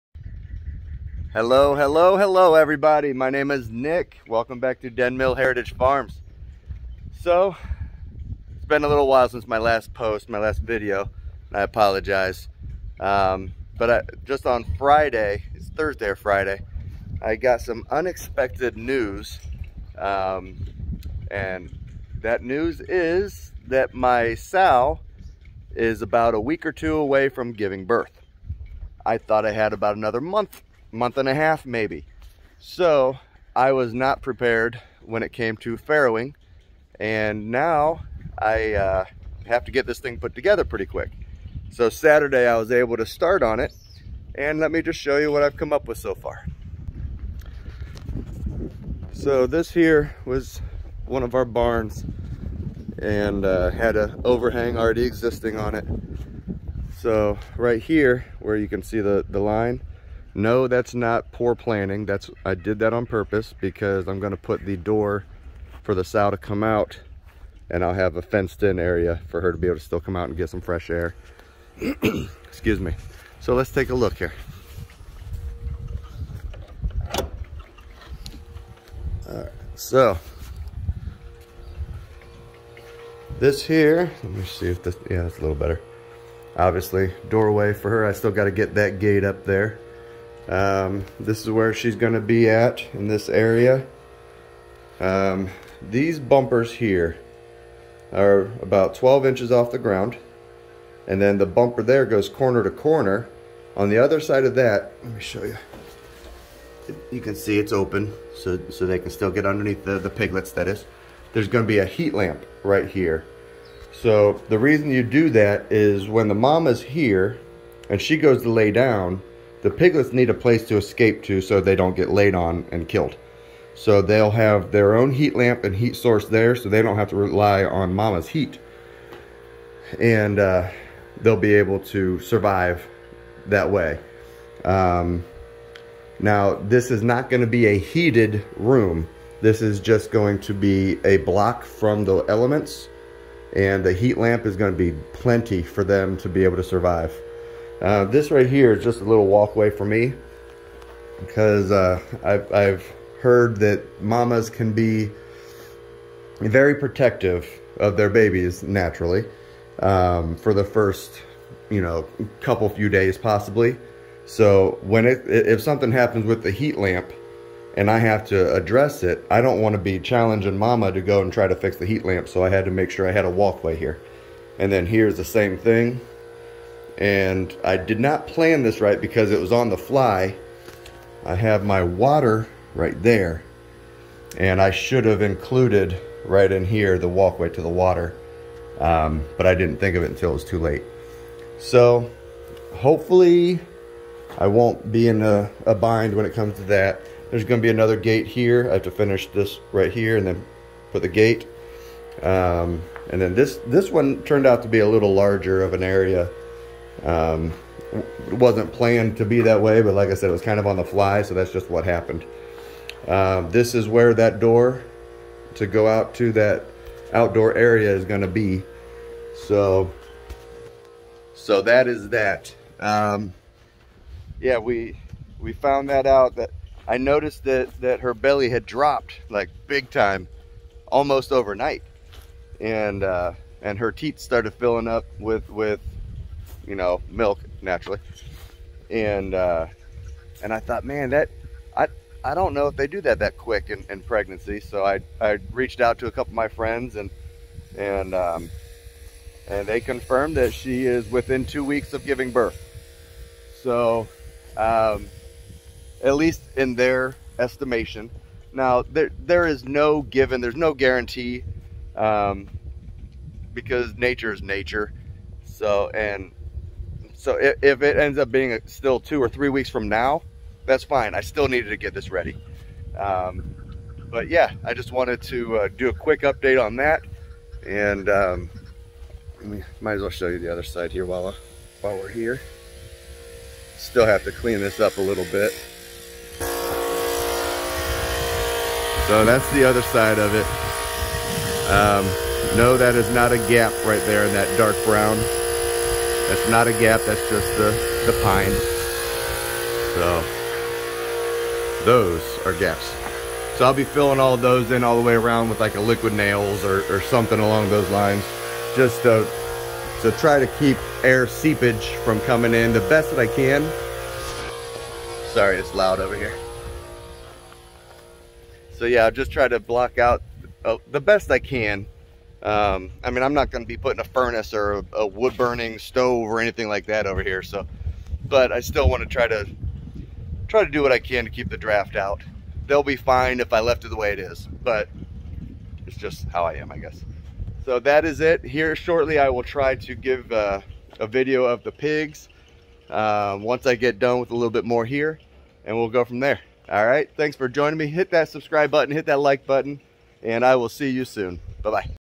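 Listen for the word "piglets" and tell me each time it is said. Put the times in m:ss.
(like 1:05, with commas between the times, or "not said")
1:50, 1:59.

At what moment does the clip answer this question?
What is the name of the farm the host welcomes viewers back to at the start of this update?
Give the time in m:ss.
0:04.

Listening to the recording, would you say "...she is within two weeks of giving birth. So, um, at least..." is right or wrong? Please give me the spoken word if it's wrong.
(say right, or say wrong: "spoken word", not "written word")
right.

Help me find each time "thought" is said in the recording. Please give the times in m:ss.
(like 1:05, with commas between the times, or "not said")
0:29, 4:00.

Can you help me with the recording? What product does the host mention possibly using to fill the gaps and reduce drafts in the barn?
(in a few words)
liquid nails.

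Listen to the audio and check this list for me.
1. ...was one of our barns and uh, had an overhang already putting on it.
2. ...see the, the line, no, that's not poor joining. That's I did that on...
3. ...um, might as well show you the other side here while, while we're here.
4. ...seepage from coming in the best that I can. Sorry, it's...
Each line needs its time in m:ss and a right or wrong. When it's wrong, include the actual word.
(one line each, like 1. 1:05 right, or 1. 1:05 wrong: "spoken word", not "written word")
1. 0:50 wrong: "existing", not "putting"
2. 0:58 wrong: "planning", not "joining"
3. 4:38 right
4. 5:11 right.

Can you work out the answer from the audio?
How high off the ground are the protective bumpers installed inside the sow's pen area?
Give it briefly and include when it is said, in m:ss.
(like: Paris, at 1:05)
12 inches, at 1:38.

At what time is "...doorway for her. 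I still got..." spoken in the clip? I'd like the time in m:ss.
1:27.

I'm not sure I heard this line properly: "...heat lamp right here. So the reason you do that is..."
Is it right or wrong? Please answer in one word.
right.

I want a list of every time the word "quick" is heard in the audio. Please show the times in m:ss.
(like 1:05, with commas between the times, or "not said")
0:40, 4:03, 4:35.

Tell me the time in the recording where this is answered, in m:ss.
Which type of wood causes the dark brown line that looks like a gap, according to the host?
4:58.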